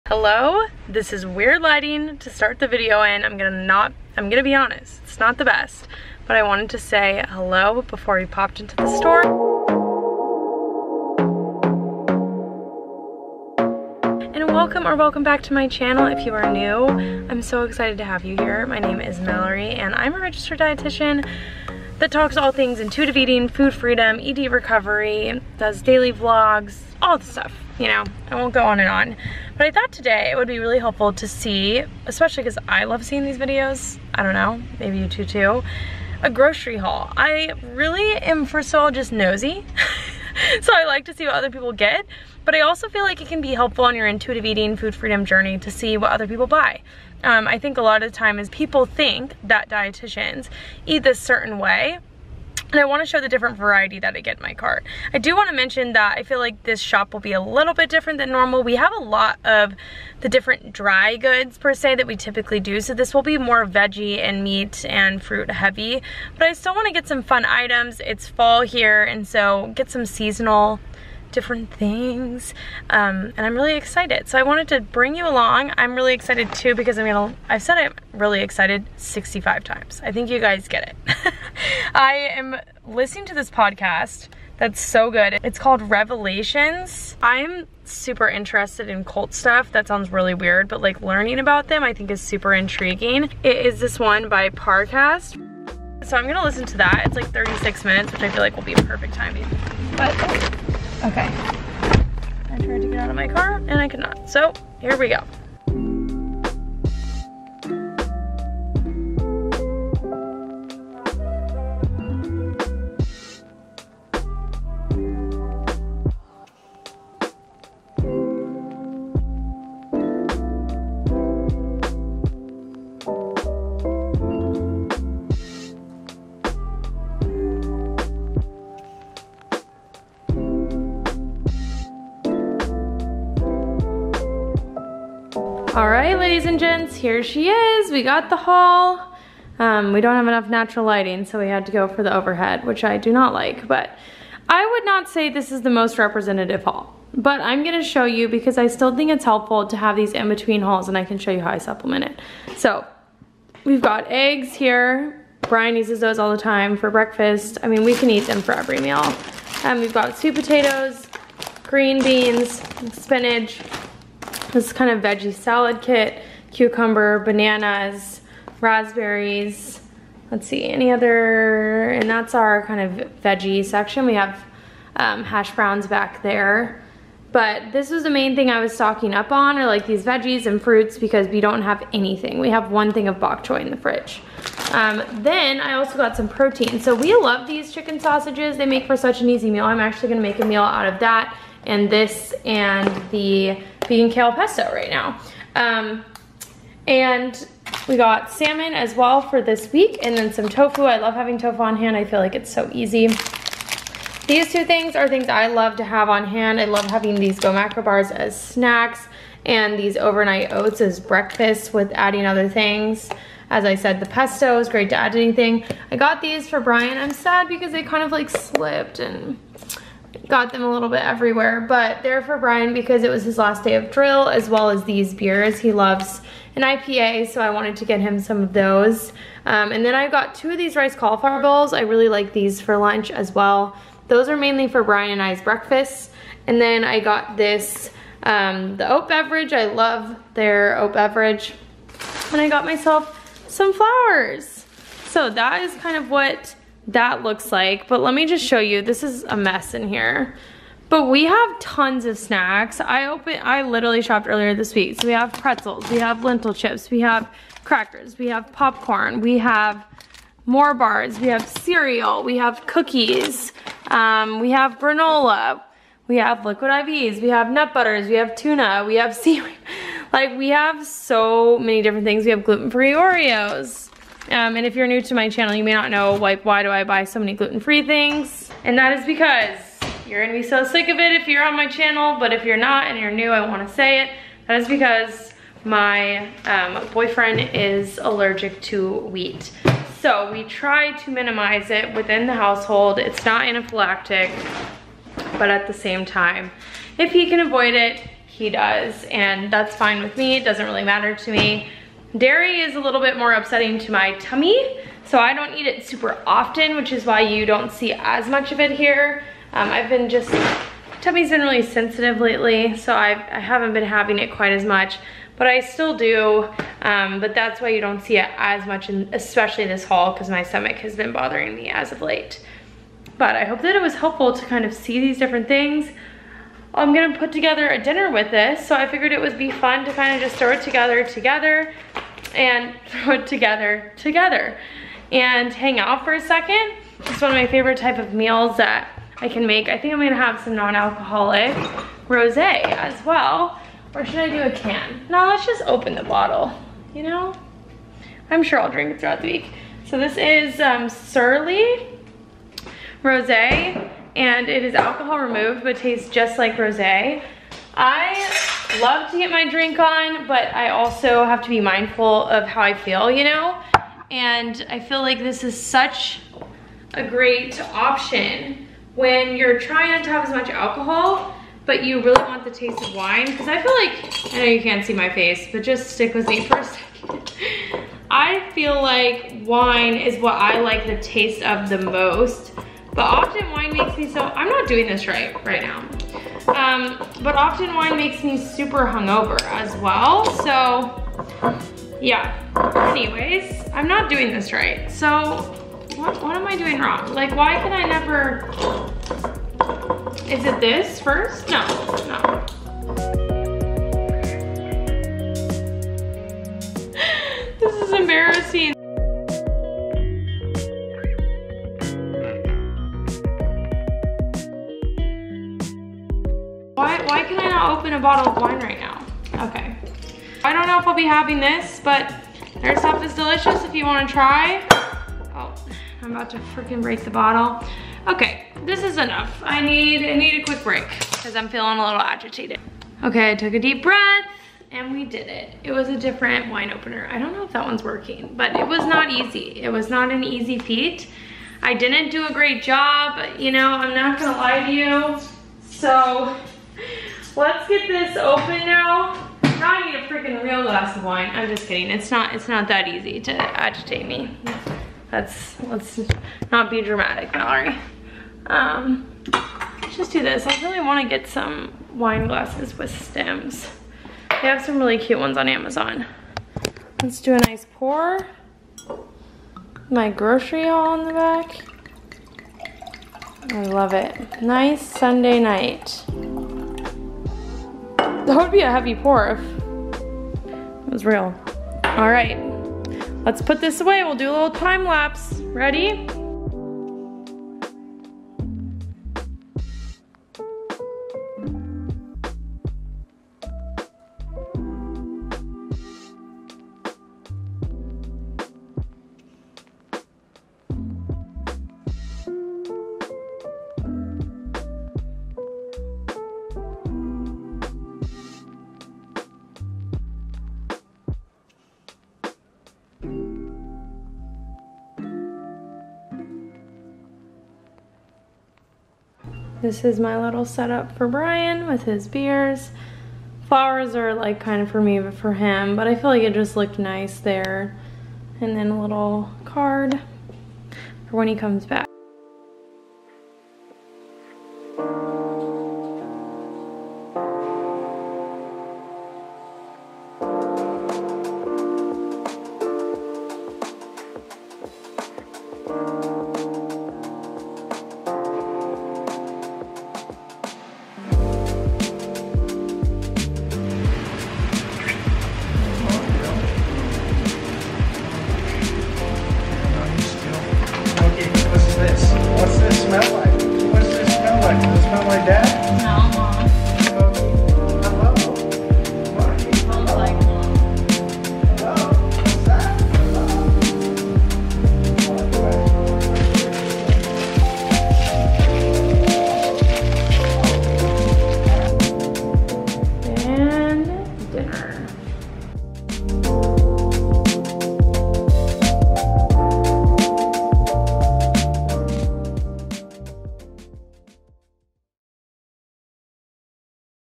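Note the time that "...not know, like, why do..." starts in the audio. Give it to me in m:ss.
4:35.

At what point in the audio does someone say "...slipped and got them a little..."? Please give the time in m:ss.
3:38.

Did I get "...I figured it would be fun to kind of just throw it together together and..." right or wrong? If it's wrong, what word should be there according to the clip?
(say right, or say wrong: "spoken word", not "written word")
right.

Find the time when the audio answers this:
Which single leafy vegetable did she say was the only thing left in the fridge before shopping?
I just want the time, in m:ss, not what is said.
3:03.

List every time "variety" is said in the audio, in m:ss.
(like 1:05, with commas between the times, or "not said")
0:53.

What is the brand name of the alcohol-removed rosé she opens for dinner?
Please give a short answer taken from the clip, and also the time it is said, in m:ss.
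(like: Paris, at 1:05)
Surely, at 5:51.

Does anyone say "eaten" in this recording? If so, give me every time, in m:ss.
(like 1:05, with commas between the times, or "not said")
not said.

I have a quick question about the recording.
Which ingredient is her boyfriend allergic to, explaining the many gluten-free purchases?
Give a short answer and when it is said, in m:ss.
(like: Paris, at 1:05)
wheat, at 4:48.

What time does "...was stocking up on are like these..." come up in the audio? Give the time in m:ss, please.
2:58.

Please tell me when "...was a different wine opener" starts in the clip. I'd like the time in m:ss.
7:15.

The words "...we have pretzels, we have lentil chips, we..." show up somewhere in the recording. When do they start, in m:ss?
4:15.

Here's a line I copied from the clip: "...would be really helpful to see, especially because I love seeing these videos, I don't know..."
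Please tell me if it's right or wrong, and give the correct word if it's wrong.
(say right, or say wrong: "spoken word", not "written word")
right.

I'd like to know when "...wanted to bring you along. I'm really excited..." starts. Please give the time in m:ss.
1:14.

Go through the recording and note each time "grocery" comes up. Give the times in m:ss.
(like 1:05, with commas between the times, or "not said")
0:36, 7:50.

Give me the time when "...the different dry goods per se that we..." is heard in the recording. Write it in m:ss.
1:00.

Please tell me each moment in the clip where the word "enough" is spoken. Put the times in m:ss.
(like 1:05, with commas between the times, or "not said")
2:20, 7:08.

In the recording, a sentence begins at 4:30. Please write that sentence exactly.
Like we have so many different things.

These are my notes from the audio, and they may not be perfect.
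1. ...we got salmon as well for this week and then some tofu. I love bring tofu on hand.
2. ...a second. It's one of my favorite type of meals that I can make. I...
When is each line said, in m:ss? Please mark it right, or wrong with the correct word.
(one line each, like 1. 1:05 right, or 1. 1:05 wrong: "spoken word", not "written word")
1. 3:17 wrong: "having", not "bring"
2. 5:36 right.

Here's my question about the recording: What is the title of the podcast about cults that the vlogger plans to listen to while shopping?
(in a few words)
Revelations.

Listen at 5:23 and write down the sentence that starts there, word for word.
But I hope that it was helpful to kind of see these different things.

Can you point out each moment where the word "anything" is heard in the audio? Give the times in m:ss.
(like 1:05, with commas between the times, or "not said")
3:01, 3:35.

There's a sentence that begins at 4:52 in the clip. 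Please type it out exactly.
It's not anaphylactic, but at the same time, if he can avoid it, he does.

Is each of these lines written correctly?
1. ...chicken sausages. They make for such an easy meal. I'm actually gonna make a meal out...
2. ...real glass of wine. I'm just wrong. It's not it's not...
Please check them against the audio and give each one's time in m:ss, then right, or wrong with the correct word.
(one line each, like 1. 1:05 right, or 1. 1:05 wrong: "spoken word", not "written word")
1. 3:07 right
2. 7:30 wrong: "kidding", not "wrong".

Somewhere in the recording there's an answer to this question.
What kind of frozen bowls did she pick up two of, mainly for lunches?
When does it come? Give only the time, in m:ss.
3:50.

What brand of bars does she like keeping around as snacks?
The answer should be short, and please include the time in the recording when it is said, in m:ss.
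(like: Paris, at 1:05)
Go Macro, at 3:27.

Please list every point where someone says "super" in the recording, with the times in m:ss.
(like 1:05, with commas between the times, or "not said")
1:27, 1:32, 5:05, 6:28.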